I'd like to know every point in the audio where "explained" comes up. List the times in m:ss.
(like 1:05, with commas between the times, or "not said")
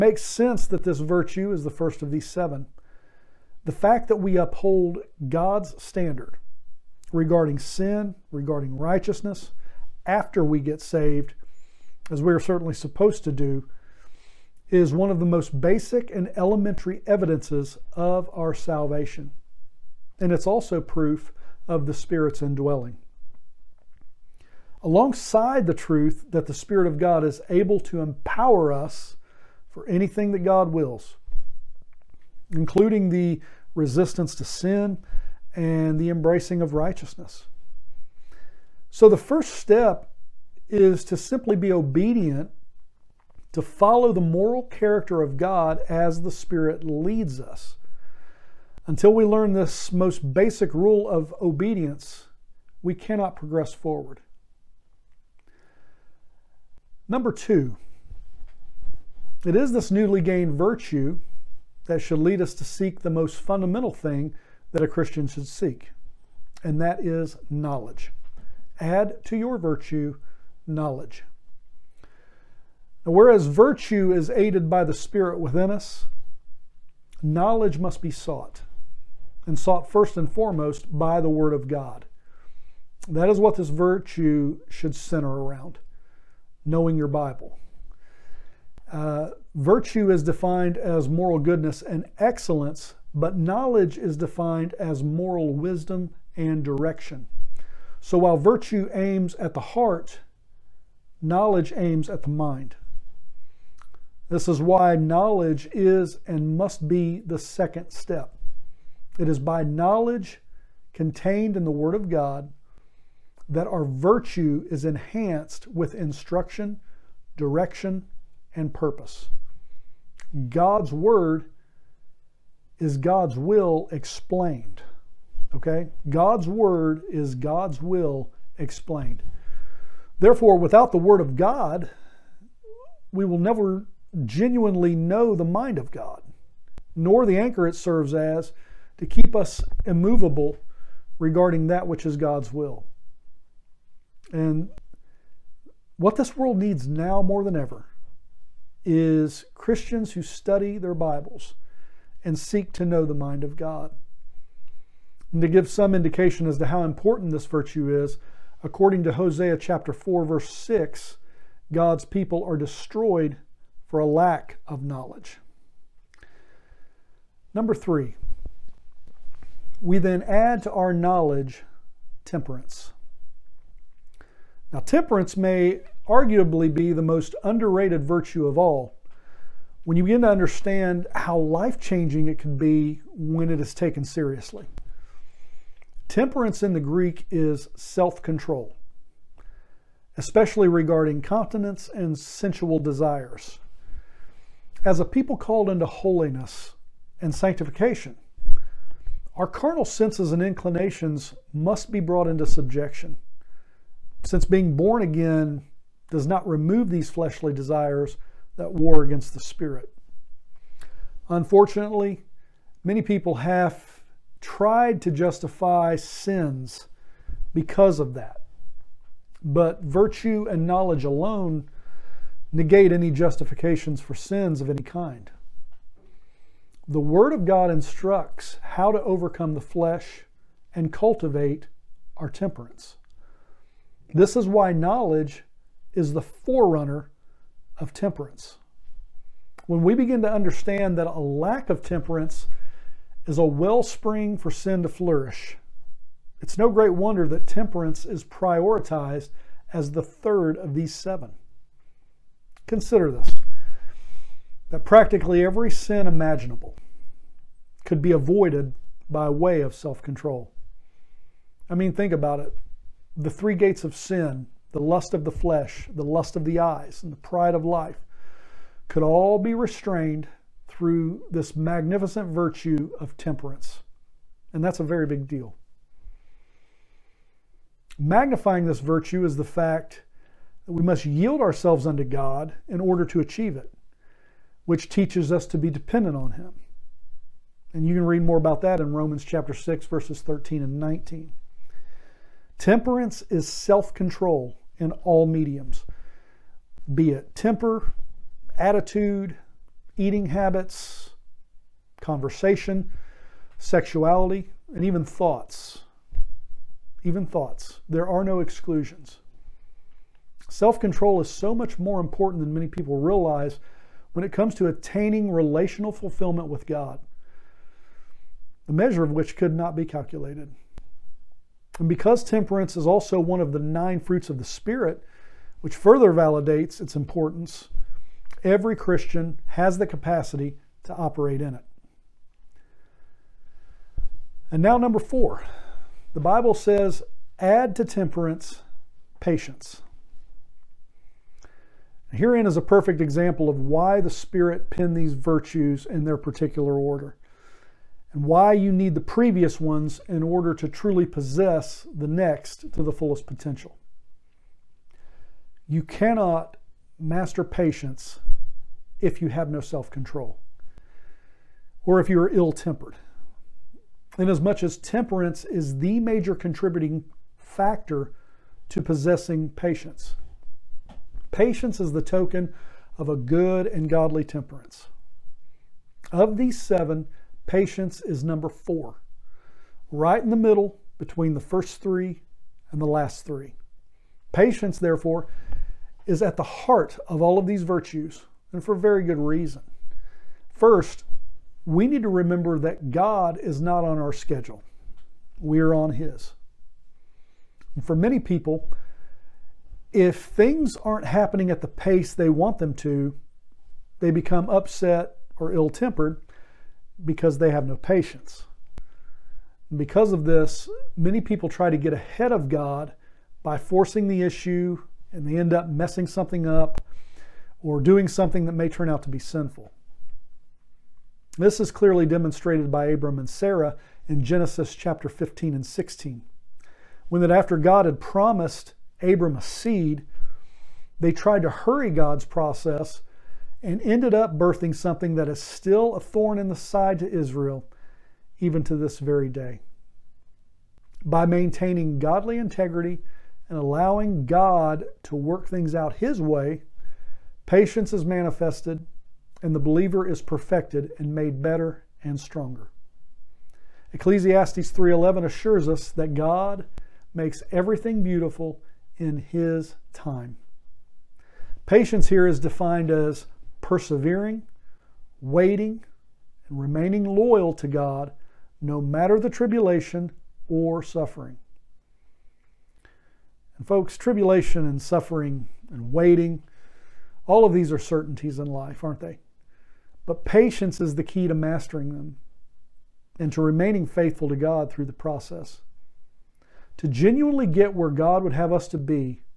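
2:03, 2:08.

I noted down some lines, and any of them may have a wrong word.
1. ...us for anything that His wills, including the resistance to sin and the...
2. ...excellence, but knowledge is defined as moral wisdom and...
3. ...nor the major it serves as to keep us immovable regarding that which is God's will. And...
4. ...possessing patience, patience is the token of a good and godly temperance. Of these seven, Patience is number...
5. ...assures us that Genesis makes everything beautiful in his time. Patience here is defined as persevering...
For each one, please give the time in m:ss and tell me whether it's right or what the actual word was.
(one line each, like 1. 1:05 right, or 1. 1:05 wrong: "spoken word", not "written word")
1. 0:28 wrong: "God", not "His"
2. 1:32 right
3. 2:16 wrong: "anchor", not "major"
4. 6:08 right
5. 7:35 wrong: "God", not "Genesis".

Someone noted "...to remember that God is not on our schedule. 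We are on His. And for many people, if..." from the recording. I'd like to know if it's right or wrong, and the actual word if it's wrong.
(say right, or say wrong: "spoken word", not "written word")
right.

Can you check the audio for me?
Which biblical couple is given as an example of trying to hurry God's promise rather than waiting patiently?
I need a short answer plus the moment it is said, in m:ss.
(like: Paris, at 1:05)
Abram and Sarah, at 7:02.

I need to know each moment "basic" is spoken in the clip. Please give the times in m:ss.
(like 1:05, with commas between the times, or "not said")
0:15, 0:50.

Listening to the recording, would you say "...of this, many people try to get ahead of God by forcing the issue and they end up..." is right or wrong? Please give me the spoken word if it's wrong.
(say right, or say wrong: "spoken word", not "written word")
right.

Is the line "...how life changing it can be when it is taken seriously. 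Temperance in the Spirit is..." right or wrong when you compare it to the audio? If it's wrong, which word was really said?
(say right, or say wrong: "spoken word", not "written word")
wrong: "Greek", not "Spirit".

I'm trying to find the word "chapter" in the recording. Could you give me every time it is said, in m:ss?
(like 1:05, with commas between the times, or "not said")
2:39, 4:49, 7:04.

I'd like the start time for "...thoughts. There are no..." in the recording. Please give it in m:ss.
5:07.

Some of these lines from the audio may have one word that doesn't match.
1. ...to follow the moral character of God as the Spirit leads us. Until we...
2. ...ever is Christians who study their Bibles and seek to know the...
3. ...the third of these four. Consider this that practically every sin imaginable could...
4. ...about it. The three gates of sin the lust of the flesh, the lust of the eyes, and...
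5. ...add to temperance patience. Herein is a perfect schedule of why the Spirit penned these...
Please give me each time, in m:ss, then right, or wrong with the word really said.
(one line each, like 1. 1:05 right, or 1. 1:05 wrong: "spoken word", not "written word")
1. 0:43 right
2. 2:27 right
3. 4:09 wrong: "seven", not "four"
4. 4:22 right
5. 5:37 wrong: "example", not "schedule".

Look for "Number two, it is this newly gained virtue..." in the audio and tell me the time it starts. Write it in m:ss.
0:57.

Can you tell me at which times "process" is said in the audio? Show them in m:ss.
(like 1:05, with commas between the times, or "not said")
7:12, 8:04.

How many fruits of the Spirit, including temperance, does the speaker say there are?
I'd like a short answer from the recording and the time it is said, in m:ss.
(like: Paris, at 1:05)
9, at 5:23.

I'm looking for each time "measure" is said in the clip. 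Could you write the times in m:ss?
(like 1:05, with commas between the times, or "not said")
5:18.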